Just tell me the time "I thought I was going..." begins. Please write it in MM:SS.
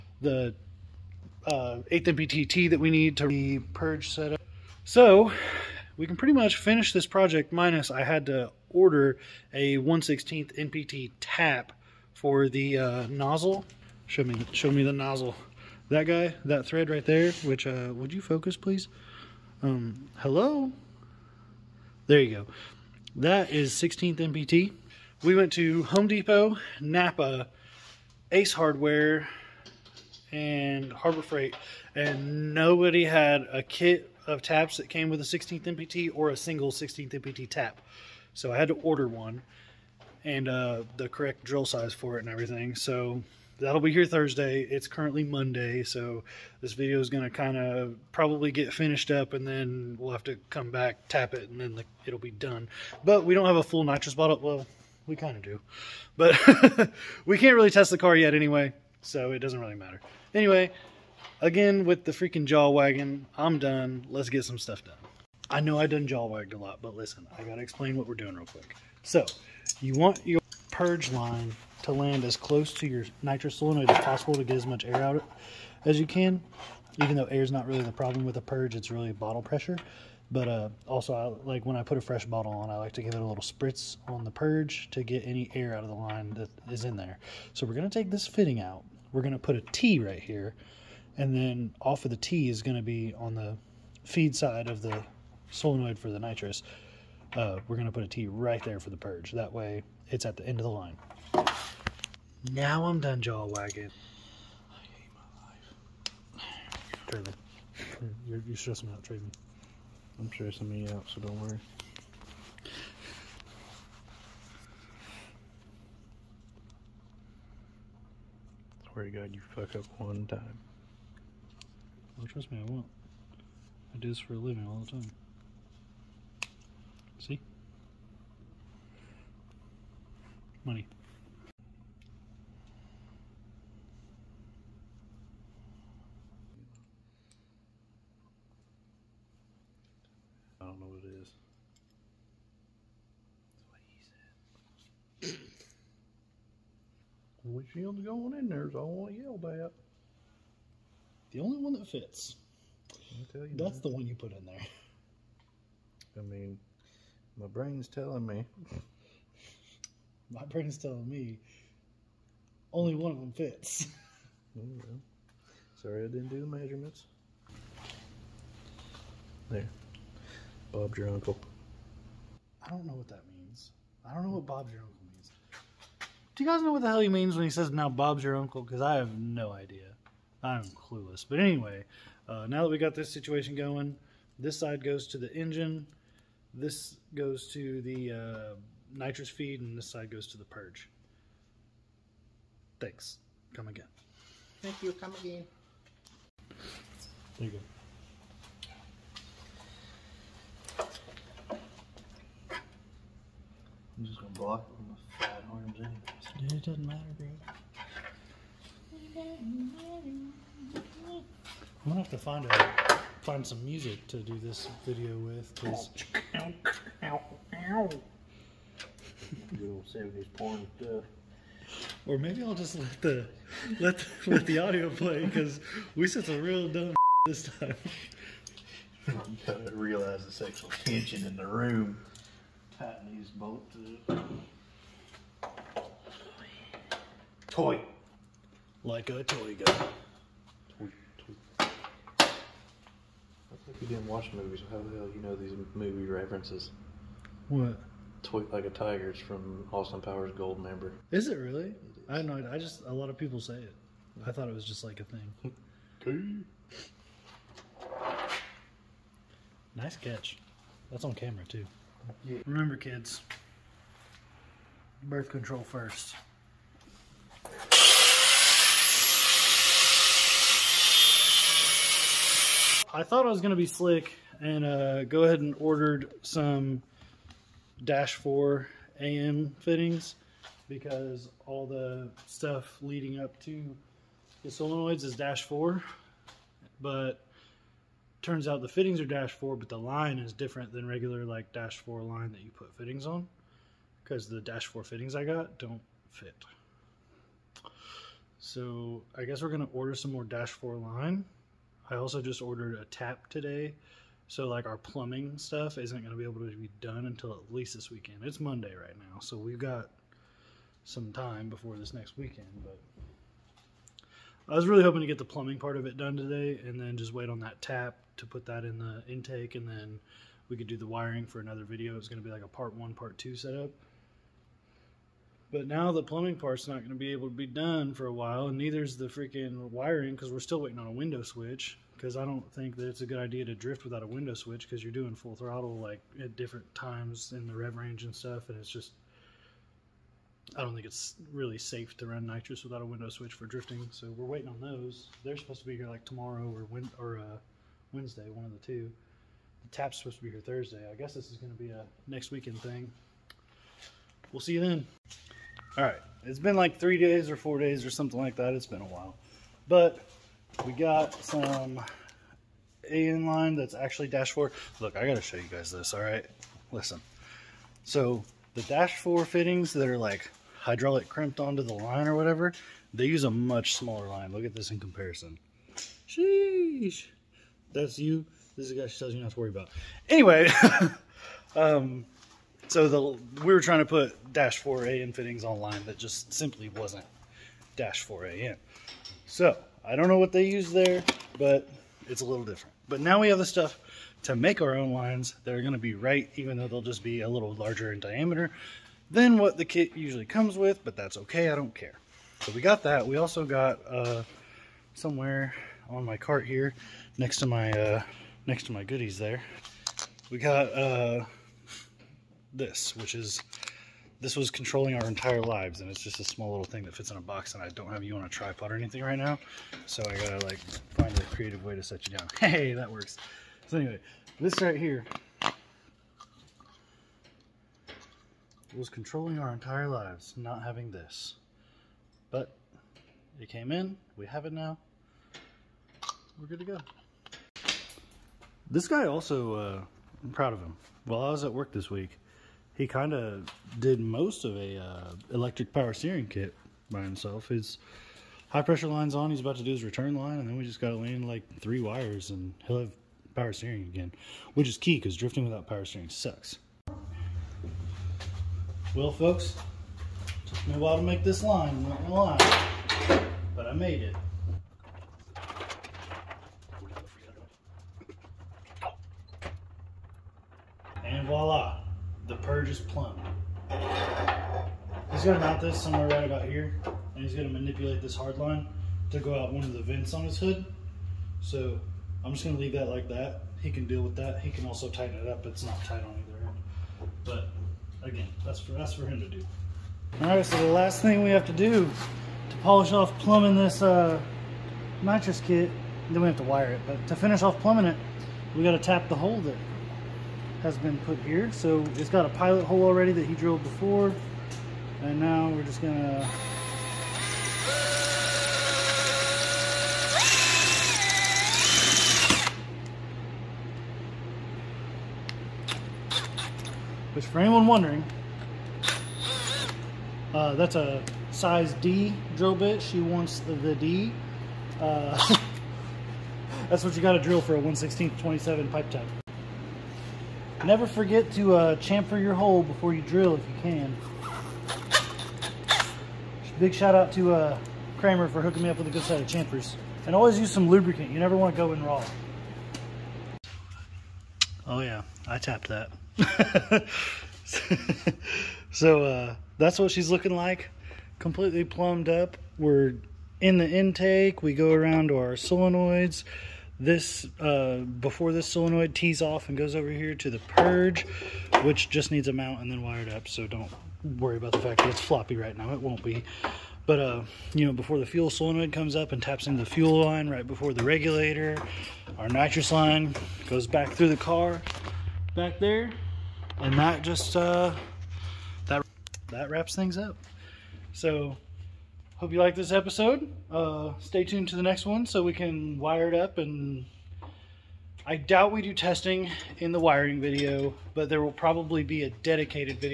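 04:32.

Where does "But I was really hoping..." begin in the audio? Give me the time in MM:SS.
05:12.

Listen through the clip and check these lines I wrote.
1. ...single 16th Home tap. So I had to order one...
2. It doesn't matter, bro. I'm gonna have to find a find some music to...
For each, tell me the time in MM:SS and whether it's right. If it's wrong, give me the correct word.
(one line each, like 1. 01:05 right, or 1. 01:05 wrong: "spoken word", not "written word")
1. 00:36 wrong: "NPT", not "Home"
2. 03:26 right.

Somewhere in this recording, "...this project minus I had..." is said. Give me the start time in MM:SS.
00:06.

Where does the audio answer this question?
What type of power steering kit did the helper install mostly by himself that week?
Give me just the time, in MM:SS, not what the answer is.
07:25.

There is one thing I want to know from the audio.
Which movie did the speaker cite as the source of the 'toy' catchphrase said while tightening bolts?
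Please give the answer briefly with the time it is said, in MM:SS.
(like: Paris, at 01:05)
Austin Powers Goldmember, at 04:09.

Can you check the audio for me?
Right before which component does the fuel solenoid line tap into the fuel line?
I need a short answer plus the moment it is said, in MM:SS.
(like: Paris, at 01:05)
The regulator, at 09:30.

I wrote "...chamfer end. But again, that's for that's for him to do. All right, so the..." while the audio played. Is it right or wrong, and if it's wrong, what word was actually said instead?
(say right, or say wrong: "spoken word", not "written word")
wrong: "either", not "chamfer".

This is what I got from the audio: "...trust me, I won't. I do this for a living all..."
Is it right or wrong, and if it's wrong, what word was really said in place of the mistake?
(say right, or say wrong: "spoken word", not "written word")
right.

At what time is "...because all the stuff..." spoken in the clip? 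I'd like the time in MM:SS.
04:40.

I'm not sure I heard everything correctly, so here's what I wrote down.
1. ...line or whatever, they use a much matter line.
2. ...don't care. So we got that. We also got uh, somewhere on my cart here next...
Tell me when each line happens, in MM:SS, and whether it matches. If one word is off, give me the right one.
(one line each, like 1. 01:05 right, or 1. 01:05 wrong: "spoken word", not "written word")
1. 06:11 wrong: "smaller", not "matter"
2. 06:41 right.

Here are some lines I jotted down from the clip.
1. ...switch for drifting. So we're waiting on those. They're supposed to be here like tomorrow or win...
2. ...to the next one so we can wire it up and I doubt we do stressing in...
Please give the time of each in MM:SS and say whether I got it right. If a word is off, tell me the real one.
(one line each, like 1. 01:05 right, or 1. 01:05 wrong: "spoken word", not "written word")
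1. 05:43 right
2. 09:44 wrong: "testing", not "stressing".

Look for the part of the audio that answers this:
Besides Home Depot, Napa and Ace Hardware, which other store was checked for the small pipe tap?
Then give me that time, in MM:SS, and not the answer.
00:30.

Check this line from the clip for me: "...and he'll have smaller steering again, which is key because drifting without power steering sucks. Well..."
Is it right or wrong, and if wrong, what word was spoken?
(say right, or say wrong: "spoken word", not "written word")
wrong: "power", not "smaller".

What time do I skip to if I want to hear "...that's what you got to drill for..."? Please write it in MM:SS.
08:46.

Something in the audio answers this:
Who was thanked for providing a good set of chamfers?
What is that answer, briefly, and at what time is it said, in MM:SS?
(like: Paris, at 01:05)
Kramer, at 08:57.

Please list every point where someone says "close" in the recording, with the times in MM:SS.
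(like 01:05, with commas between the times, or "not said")
01:12.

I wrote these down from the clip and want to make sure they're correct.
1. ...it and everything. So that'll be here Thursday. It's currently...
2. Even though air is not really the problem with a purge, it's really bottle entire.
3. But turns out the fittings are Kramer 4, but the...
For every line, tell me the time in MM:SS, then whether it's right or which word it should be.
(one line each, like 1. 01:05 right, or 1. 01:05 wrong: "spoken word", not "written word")
1. 00:42 right
2. 01:17 wrong: "pressure", not "entire"
3. 04:46 wrong: "Dash", not "Kramer".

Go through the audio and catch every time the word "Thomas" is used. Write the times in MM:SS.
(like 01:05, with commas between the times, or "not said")
not said.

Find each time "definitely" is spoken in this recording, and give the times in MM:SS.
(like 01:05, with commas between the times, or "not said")
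not said.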